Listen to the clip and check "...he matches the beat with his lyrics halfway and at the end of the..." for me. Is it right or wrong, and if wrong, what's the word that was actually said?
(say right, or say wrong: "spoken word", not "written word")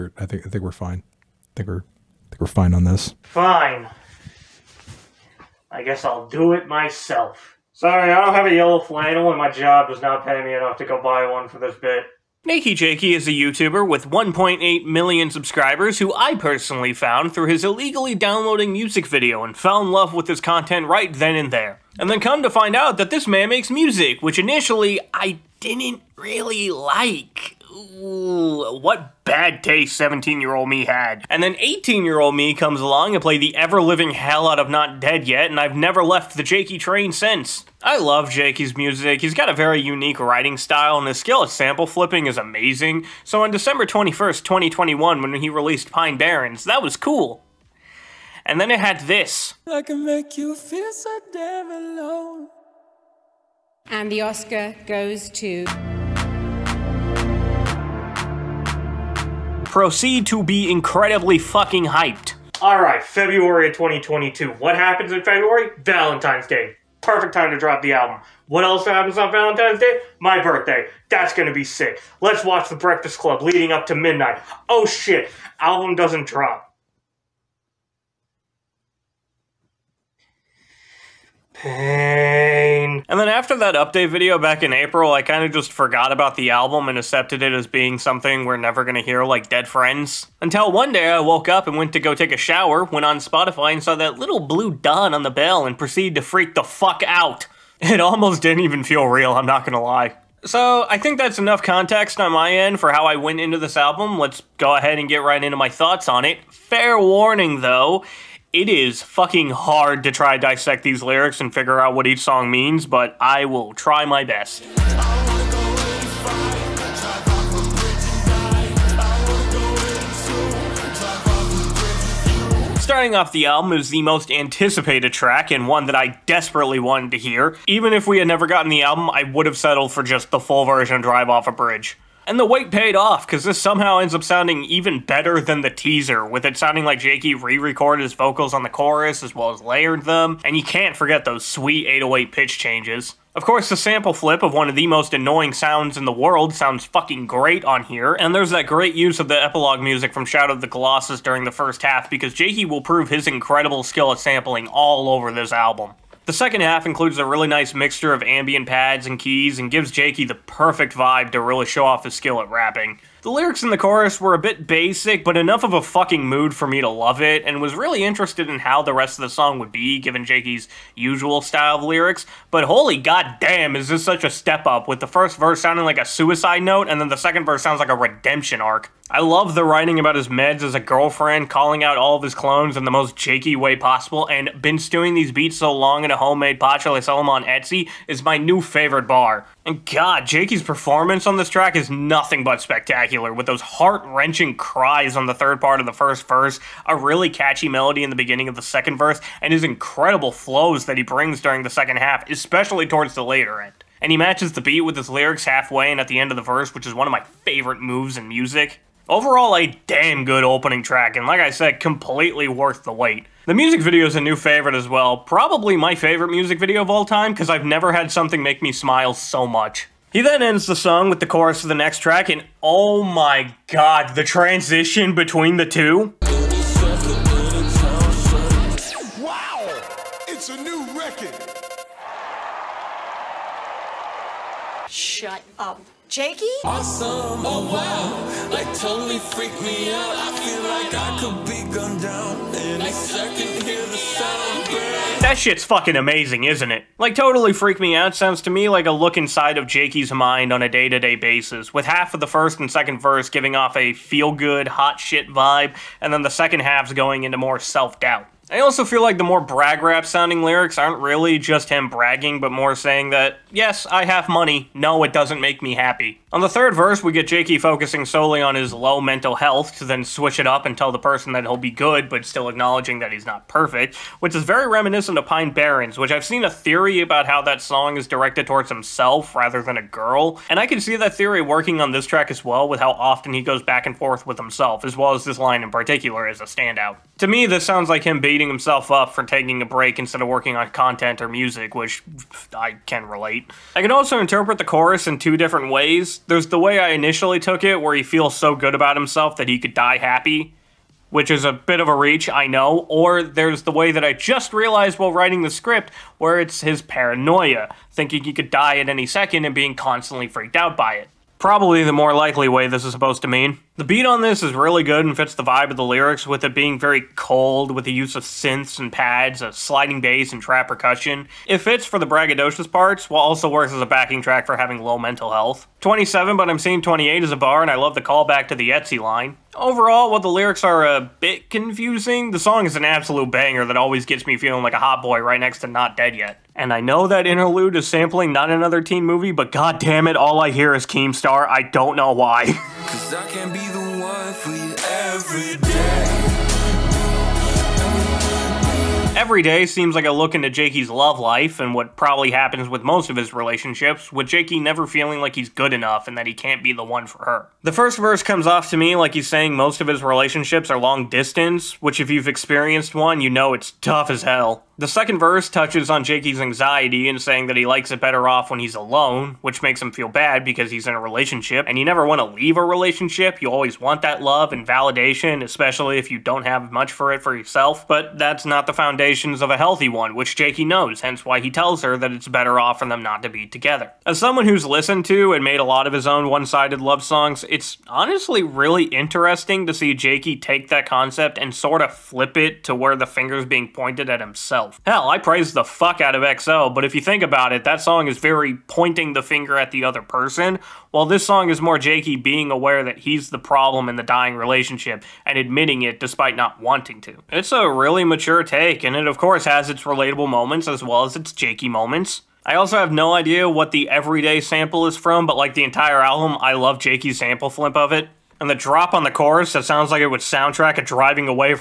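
right.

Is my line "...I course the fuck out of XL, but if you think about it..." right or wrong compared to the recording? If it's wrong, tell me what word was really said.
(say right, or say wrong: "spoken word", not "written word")
wrong: "praise", not "course".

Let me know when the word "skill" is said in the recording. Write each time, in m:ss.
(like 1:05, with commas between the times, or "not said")
0:41, 2:33, 2:42.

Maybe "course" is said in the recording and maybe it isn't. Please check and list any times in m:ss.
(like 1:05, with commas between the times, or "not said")
2:23, 6:49.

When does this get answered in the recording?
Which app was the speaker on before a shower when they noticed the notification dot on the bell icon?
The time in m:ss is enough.
1:33.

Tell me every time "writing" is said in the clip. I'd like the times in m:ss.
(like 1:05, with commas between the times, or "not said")
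0:40, 2:59, 5:05.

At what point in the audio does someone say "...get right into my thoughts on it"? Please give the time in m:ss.
1:45.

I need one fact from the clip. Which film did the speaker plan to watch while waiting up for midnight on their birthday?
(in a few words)
The Breakfast Club.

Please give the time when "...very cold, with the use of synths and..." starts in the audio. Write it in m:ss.
5:16.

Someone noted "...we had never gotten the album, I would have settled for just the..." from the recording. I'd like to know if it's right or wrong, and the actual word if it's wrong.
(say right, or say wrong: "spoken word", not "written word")
right.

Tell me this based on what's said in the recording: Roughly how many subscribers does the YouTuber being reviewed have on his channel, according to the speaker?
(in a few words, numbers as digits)
1.8 million.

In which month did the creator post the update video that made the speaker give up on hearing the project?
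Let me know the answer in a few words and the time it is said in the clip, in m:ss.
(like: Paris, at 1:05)
April, at 1:24.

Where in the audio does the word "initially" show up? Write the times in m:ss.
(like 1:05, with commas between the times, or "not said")
0:24, 4:56.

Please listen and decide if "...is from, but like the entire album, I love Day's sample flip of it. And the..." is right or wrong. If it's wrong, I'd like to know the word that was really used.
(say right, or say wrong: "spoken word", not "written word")
wrong: "Jakey", not "Day".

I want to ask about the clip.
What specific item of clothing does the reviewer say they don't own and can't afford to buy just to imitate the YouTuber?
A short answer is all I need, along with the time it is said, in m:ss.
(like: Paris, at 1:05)
yellow flannel, at 0:08.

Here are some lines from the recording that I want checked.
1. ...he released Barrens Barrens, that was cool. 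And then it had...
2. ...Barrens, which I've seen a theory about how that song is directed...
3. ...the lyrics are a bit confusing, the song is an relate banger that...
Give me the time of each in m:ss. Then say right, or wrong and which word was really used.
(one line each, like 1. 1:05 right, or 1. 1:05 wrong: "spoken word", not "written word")
1. 0:45 wrong: "Pine", not "Barrens"
2. 4:35 right
3. 5:30 wrong: "absolute", not "relate".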